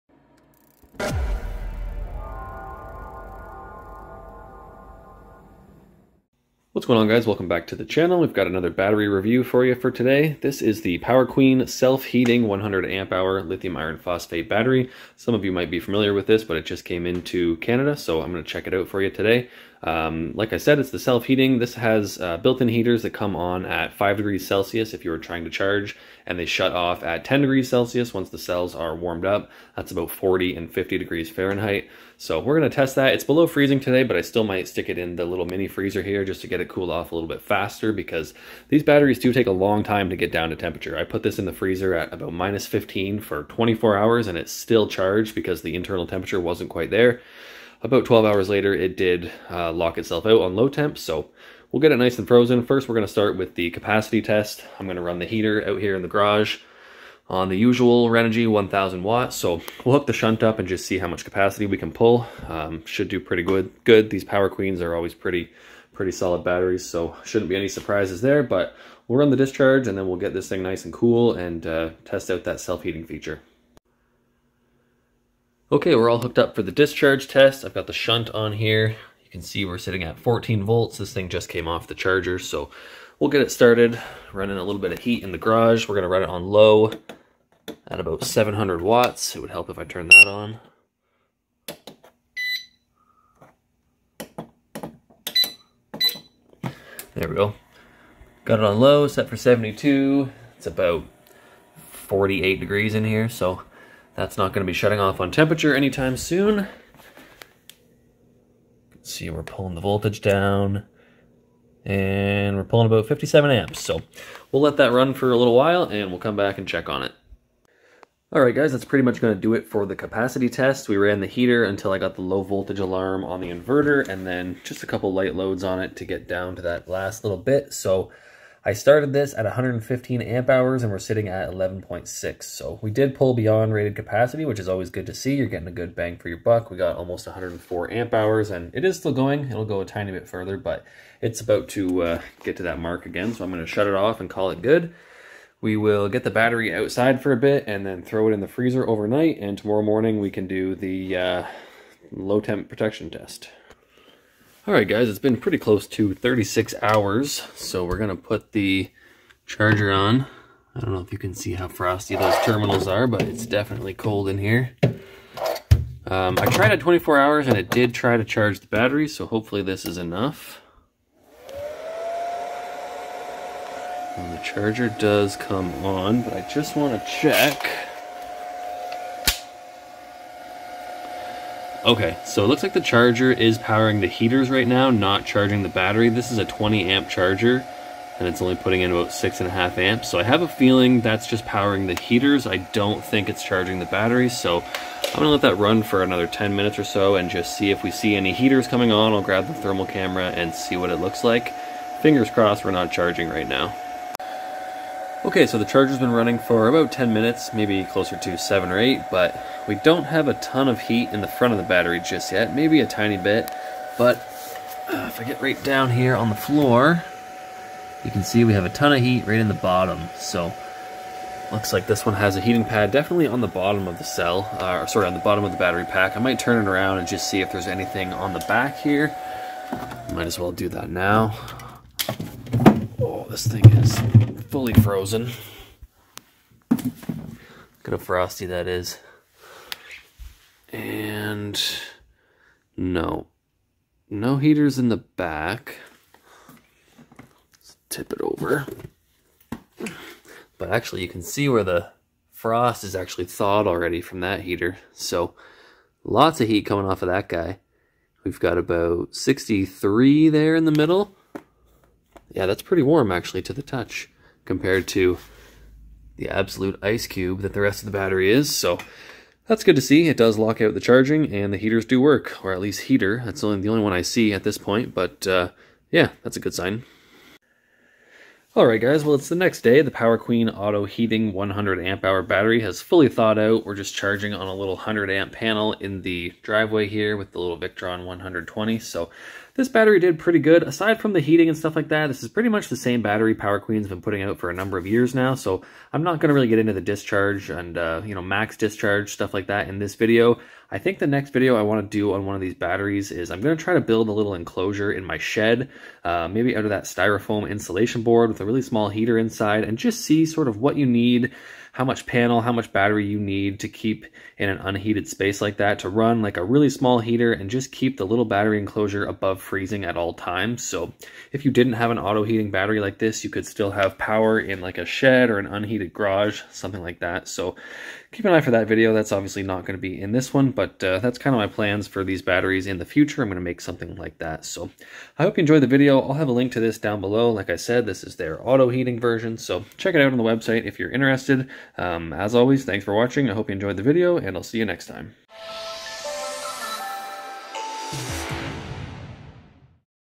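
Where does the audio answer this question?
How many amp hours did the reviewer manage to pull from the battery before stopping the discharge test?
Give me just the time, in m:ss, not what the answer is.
2:16.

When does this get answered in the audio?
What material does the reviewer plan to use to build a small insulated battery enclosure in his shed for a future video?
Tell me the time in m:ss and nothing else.
5:06.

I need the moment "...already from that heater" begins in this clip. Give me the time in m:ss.
4:13.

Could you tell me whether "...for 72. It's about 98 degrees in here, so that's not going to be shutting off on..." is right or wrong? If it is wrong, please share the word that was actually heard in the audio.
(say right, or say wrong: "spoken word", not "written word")
wrong: "48", not "98".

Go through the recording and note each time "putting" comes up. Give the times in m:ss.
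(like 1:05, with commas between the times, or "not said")
3:08, 4:54.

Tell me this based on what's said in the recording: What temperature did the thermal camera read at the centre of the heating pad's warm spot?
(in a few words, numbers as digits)
63.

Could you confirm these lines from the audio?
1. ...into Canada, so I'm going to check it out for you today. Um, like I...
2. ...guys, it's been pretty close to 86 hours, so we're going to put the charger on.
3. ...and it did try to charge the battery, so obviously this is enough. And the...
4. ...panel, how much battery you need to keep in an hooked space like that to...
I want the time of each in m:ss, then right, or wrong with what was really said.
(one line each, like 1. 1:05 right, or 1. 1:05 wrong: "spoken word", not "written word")
1. 0:17 right
2. 2:34 wrong: "36", not "86"
3. 2:47 wrong: "hopefully", not "obviously"
4. 5:12 wrong: "unheated", not "hooked".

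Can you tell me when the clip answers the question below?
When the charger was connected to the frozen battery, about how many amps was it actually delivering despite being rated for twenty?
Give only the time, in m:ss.
3:09.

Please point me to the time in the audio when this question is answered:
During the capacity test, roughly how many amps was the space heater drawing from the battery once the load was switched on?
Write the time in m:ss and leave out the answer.
1:53.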